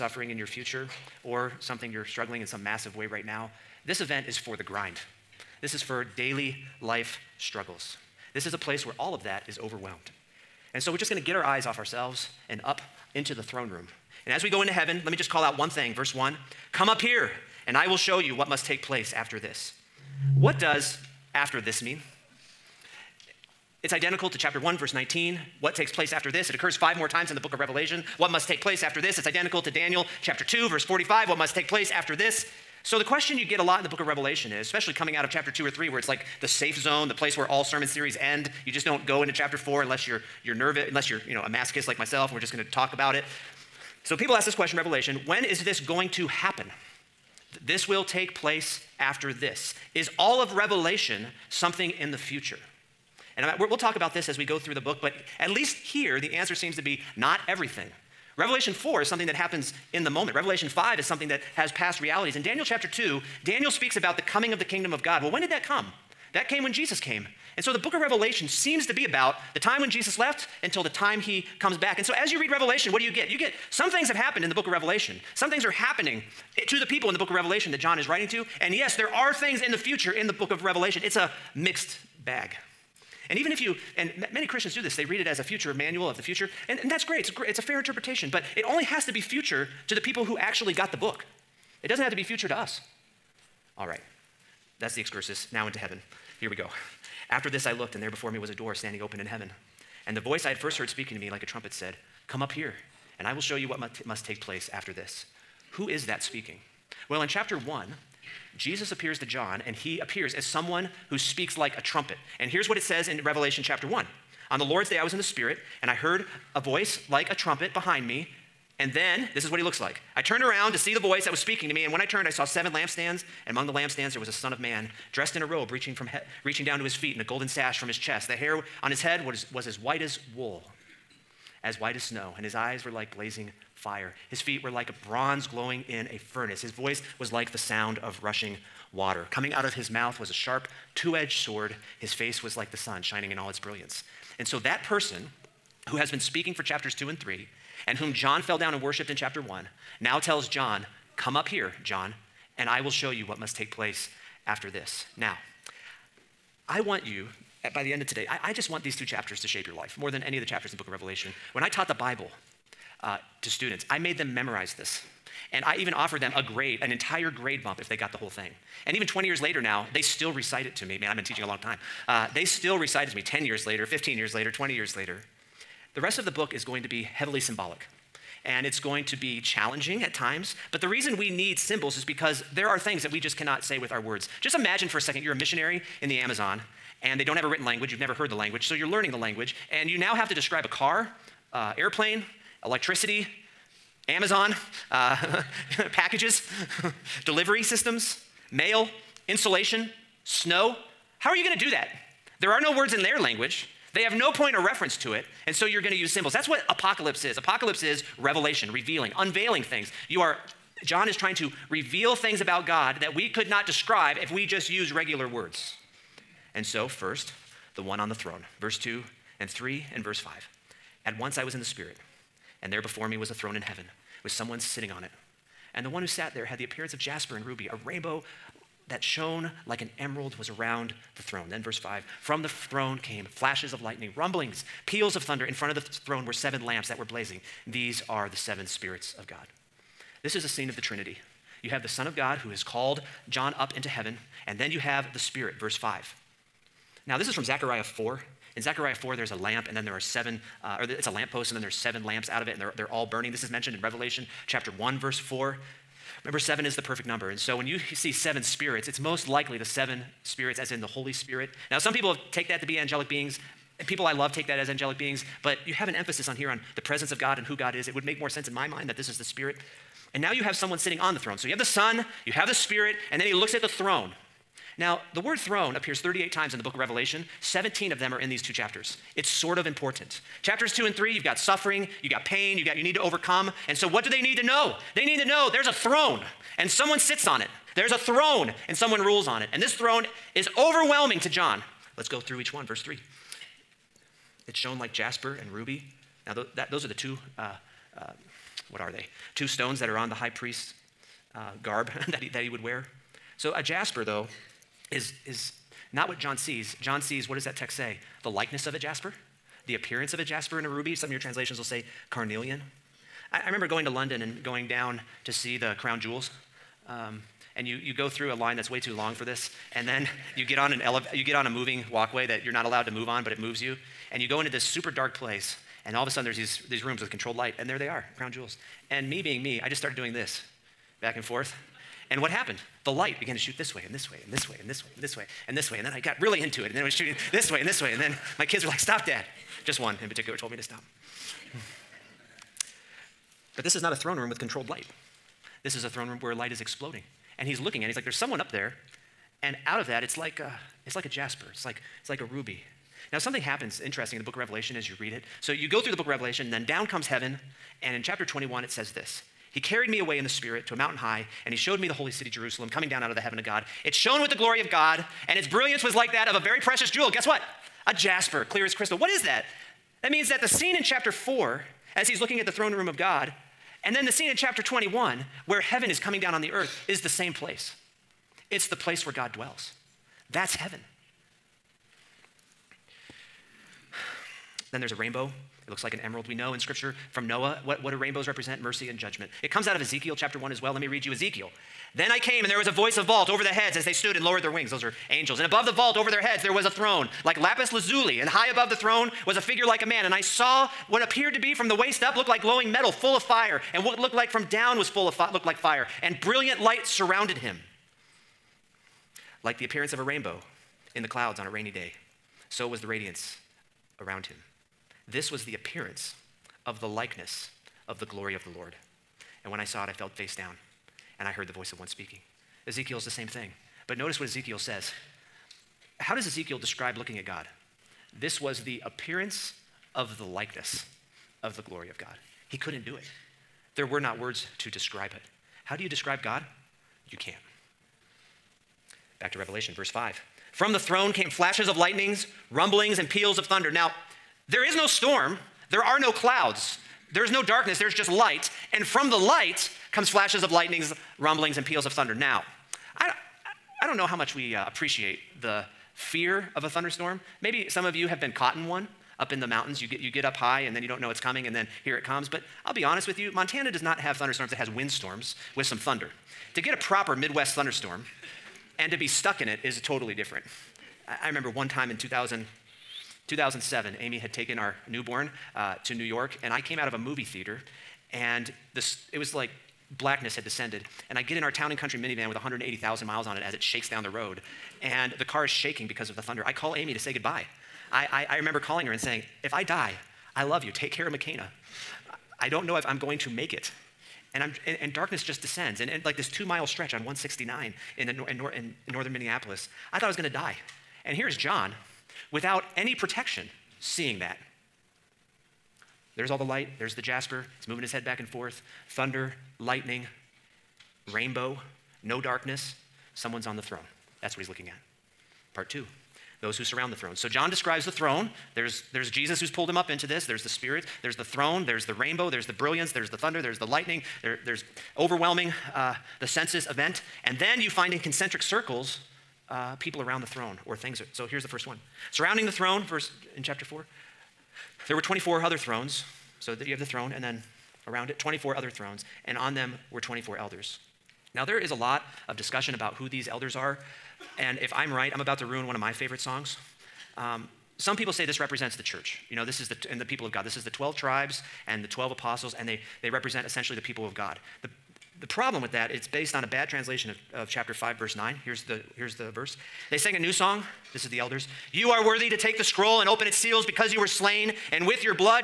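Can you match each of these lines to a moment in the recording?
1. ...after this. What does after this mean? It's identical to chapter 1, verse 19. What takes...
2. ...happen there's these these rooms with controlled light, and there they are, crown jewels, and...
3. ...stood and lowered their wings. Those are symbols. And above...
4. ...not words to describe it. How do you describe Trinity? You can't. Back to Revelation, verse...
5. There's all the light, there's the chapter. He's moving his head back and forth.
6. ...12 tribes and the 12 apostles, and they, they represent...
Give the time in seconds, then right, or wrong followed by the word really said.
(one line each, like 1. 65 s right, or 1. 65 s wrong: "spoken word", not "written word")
1. 19 s right
2. 326 s wrong: "sudden", not "happen"
3. 393 s wrong: "angels", not "symbols"
4. 433 s wrong: "God", not "Trinity"
5. 506 s wrong: "jasper", not "chapter"
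6. 550 s right.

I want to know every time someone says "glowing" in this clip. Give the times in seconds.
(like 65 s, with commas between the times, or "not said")
135 s, 402 s.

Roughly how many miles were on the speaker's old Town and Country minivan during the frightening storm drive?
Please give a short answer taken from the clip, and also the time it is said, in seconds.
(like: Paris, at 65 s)
180,000, at 482 s.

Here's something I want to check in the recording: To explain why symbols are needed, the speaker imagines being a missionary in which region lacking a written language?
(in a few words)
The Amazon.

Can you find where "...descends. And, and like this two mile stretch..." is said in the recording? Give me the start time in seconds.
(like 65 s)
495 s.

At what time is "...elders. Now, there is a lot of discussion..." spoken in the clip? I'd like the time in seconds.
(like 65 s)
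540 s.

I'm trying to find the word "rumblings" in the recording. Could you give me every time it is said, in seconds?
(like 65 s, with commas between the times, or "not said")
234 s, 442 s, 451 s.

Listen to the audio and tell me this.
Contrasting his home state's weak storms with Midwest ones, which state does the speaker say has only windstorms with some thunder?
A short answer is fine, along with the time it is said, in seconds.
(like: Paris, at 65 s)
Montana, at 463 s.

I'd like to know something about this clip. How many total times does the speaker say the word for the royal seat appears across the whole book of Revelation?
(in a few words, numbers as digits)
38.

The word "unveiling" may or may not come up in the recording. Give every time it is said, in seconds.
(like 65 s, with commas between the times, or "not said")
209 s.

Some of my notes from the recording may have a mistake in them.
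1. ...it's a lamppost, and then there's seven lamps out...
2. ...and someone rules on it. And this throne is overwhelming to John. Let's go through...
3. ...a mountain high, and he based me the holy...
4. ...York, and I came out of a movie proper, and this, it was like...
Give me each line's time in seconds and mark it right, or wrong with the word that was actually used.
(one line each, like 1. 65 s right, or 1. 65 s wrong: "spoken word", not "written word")
1. 250 s right
2. 288 s right
3. 360 s wrong: "showed", not "based"
4. 476 s wrong: "theater", not "proper".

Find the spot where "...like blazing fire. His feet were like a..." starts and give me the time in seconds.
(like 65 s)
132 s.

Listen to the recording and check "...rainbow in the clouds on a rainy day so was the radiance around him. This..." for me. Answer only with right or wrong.
right.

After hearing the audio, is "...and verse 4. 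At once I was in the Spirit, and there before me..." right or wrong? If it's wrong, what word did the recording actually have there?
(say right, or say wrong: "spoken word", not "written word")
wrong: "5", not "4".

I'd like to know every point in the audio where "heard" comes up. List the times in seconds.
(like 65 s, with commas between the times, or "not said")
100 s, 115 s, 188 s, 421 s.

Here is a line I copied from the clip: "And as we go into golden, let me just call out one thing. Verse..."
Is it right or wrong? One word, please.
wrong.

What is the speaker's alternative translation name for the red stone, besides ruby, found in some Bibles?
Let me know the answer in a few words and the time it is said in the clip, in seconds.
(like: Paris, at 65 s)
Carnelian, at 312 s.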